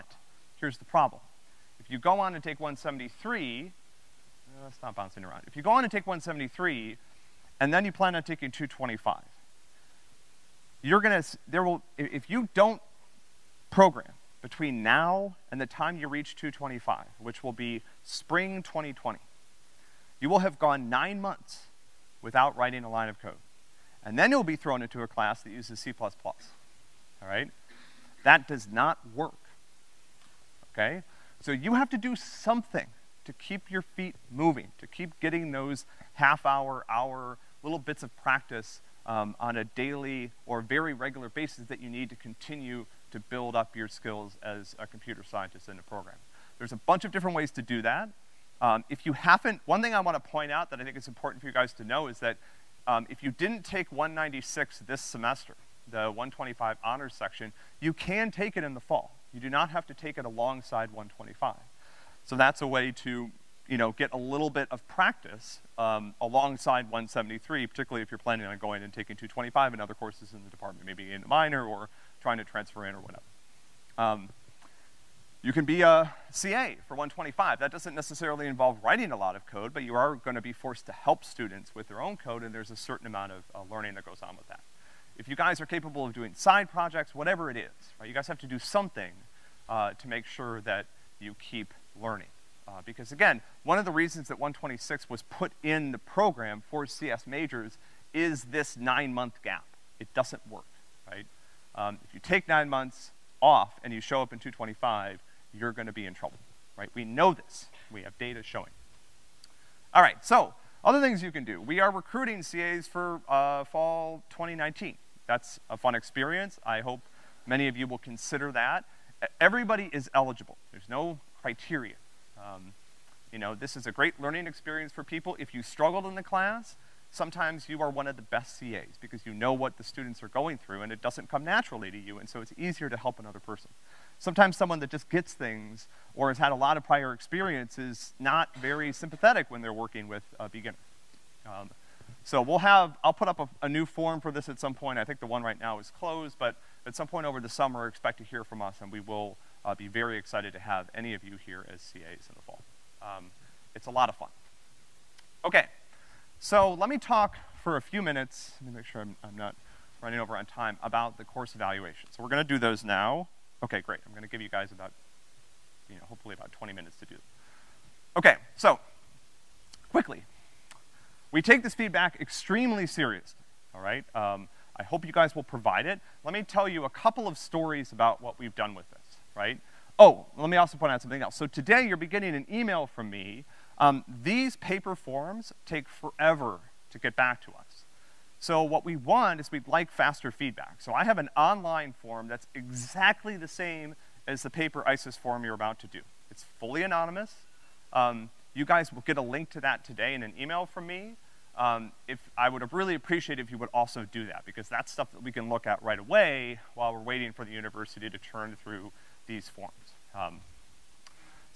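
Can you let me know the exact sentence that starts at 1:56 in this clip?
I hope many of you will consider that.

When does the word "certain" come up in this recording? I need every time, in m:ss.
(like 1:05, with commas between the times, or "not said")
1:22.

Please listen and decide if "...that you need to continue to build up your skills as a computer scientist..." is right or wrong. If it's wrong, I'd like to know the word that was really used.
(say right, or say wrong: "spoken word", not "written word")
right.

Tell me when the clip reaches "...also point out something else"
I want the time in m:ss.
3:00.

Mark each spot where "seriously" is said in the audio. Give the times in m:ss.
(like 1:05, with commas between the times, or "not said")
2:52.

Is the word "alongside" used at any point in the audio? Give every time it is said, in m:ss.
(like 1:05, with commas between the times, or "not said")
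1:00, 1:06.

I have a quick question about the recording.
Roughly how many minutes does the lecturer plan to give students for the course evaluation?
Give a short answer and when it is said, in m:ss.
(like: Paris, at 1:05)
20, at 2:46.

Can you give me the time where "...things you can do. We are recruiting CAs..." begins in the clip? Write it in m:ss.
1:50.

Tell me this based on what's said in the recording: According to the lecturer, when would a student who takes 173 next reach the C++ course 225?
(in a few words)
spring 2020.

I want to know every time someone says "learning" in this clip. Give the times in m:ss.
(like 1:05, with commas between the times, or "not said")
1:23, 1:31, 2:04.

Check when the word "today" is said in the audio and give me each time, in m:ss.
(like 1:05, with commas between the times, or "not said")
3:01, 3:19.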